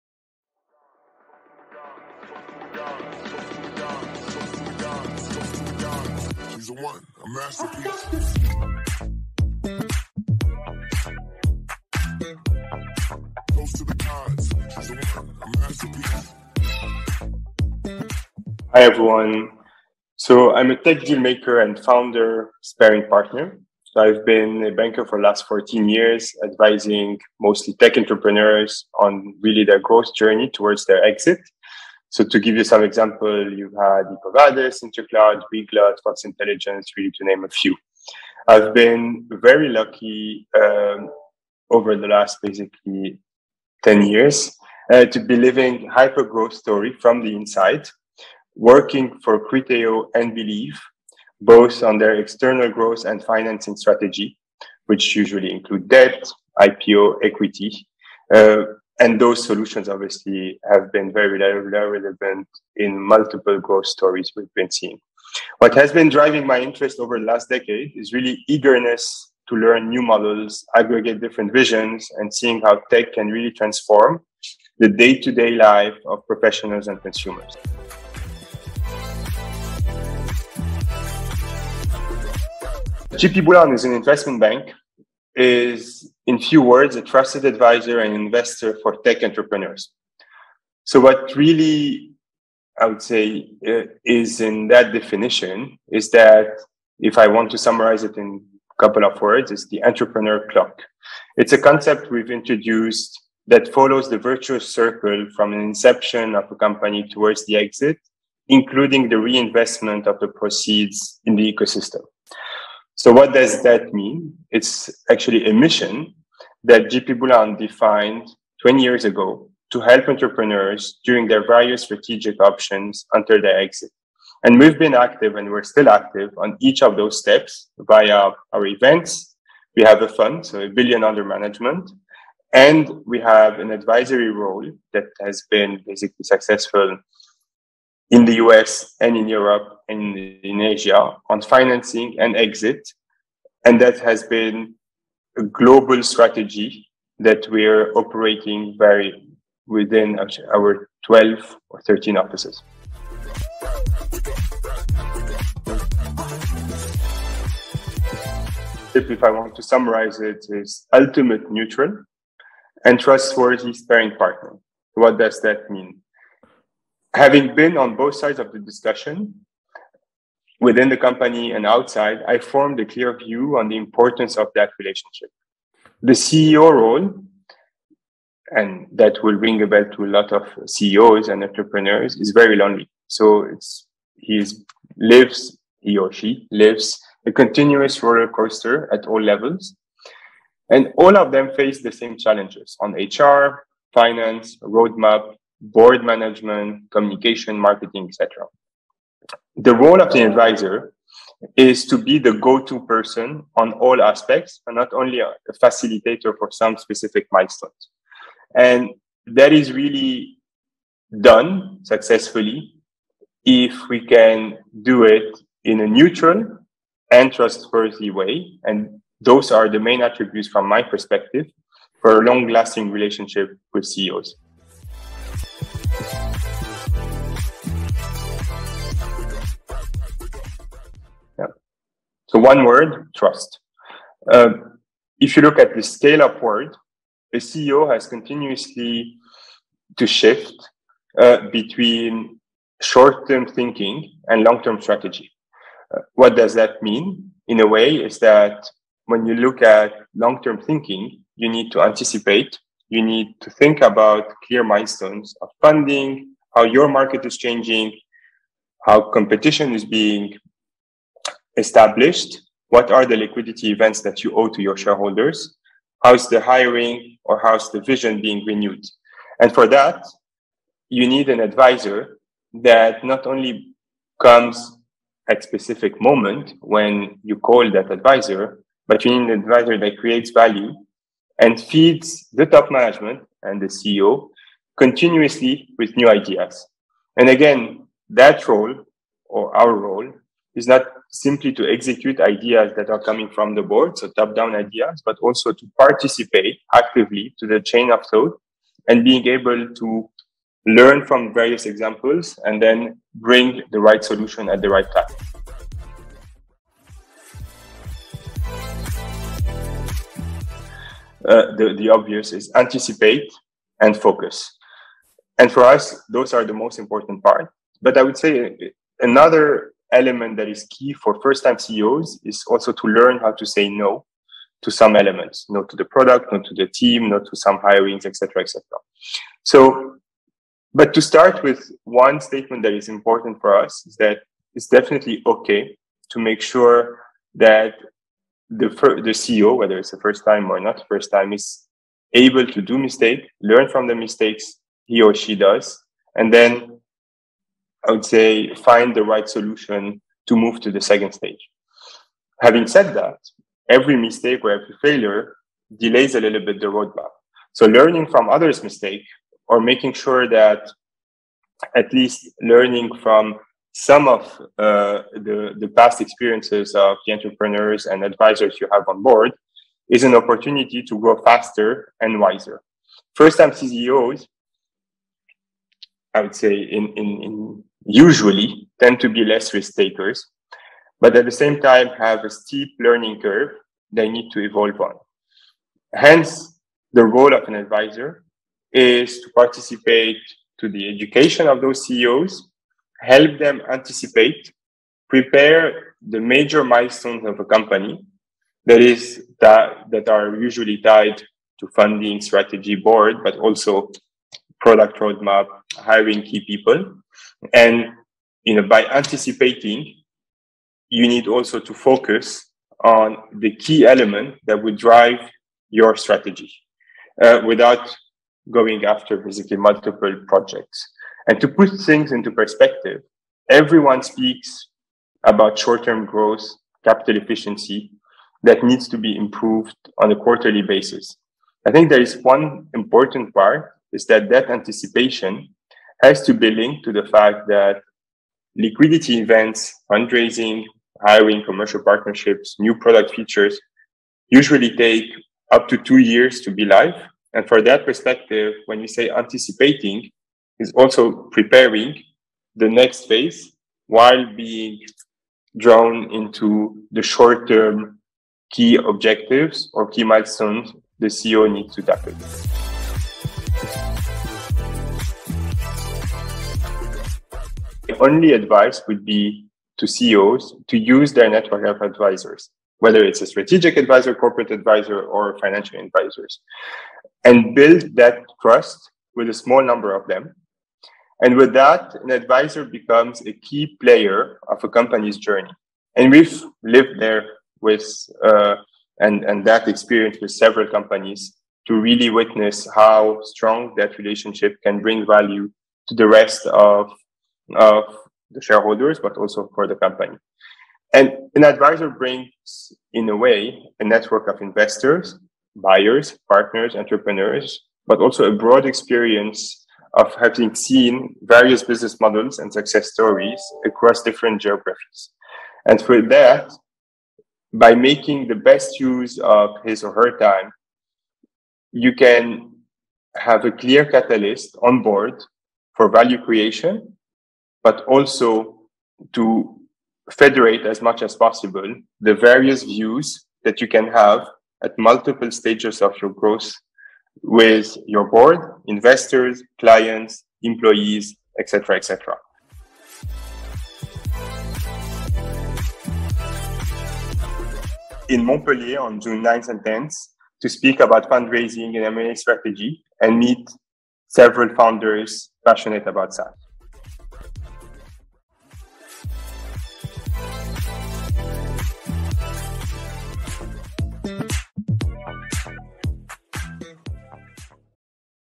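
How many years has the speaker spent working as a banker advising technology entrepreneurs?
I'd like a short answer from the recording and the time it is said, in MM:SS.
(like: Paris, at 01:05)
14 years, at 00:25.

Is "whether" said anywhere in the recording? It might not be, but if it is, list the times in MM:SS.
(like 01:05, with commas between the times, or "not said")
05:39, 07:52.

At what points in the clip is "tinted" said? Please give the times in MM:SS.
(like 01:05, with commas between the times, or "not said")
not said.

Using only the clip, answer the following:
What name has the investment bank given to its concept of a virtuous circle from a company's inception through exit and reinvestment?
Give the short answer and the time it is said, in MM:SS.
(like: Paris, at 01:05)
the entrepreneur clock, at 01:39.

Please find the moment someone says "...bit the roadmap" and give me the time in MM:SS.
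05:56.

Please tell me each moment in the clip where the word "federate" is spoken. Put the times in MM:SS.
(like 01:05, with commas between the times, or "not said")
08:50.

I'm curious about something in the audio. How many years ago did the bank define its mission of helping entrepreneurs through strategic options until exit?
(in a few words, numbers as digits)
20 years.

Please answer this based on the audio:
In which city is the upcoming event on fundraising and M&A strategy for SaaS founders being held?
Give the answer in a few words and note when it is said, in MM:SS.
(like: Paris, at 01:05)
Montpellier, at 09:08.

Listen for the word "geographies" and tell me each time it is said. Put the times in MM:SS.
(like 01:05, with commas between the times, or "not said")
08:34.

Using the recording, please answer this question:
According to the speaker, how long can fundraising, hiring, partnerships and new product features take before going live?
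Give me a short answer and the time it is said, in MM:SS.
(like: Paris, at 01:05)
2 years, at 07:25.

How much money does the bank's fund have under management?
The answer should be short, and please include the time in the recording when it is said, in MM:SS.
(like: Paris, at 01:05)
a billion, at 02:10.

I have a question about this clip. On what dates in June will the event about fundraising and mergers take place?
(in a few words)
June 9th and 10th.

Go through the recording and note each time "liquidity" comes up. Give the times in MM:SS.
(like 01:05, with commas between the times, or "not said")
04:23, 07:18.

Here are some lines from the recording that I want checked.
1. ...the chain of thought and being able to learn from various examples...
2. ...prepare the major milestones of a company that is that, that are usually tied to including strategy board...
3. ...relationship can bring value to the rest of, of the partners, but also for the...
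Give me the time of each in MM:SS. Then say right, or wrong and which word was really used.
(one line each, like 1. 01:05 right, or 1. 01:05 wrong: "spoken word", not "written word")
1. 04:57 right
2. 06:35 wrong: "funding", not "including"
3. 08:13 wrong: "shareholders", not "partners".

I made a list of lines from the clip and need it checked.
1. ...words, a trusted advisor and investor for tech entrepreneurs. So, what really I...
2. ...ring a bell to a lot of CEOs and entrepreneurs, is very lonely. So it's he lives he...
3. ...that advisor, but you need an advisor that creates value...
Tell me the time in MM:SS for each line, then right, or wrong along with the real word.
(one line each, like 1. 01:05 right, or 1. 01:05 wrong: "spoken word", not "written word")
1. 01:26 right
2. 02:59 right
3. 04:37 right.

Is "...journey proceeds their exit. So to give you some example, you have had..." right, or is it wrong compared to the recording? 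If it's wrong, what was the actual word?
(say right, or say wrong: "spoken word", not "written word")
wrong: "towards", not "proceeds".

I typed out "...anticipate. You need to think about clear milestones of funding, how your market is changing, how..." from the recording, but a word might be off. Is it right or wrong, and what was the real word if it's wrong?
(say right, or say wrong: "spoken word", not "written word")
right.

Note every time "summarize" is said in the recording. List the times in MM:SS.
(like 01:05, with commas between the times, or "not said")
01:37, 02:39.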